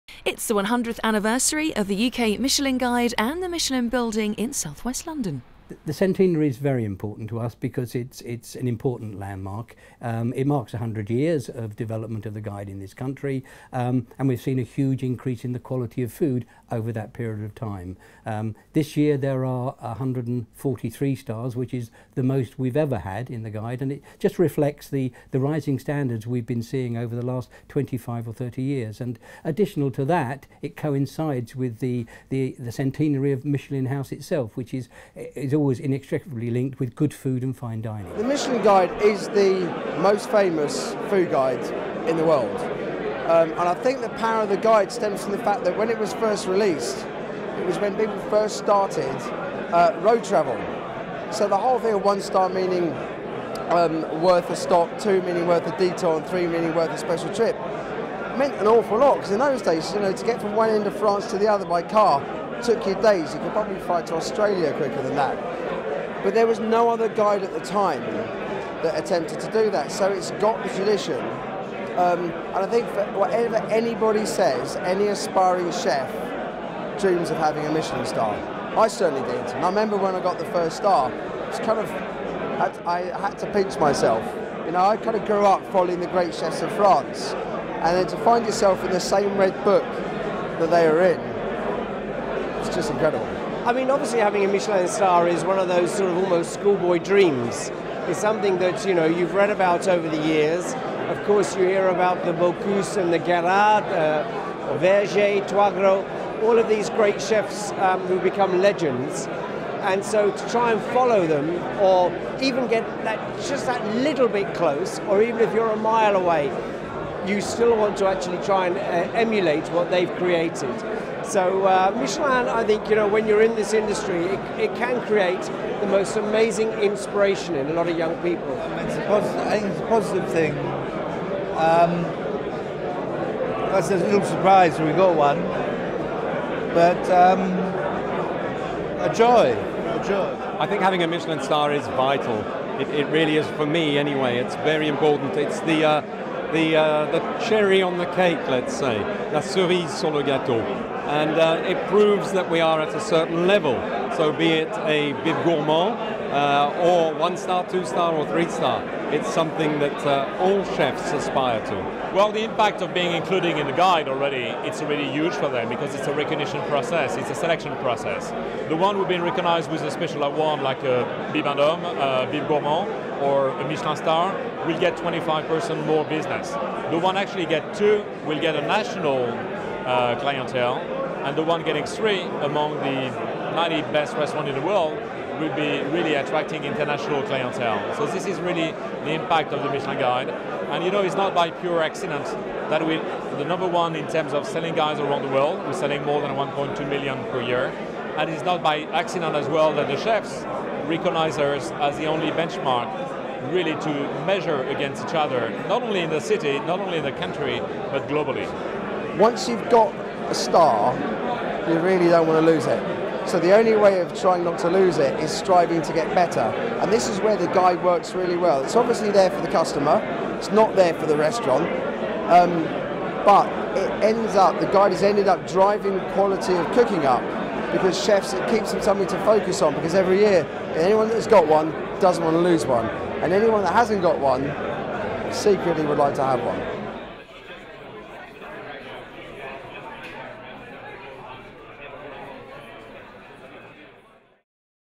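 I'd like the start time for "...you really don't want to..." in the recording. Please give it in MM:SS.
03:31.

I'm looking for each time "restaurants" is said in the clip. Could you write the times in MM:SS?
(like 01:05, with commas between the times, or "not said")
03:04, 03:41.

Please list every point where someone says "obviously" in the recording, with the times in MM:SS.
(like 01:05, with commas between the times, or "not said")
01:33, 03:38.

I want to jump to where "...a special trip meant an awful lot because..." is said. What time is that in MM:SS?
00:56.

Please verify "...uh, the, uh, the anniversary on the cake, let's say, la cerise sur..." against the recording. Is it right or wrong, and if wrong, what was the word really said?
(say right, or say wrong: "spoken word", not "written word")
wrong: "cherry", not "anniversary".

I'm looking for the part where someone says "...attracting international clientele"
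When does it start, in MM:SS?
03:06.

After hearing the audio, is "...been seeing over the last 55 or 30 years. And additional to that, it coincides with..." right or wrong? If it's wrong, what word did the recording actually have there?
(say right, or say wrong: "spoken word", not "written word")
wrong: "25", not "55".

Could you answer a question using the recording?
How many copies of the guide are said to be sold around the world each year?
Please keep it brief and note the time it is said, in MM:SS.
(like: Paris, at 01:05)
1.2 million, at 03:16.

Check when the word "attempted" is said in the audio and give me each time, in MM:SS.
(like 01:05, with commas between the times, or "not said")
01:08.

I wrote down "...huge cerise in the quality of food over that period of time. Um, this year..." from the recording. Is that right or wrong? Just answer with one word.
wrong.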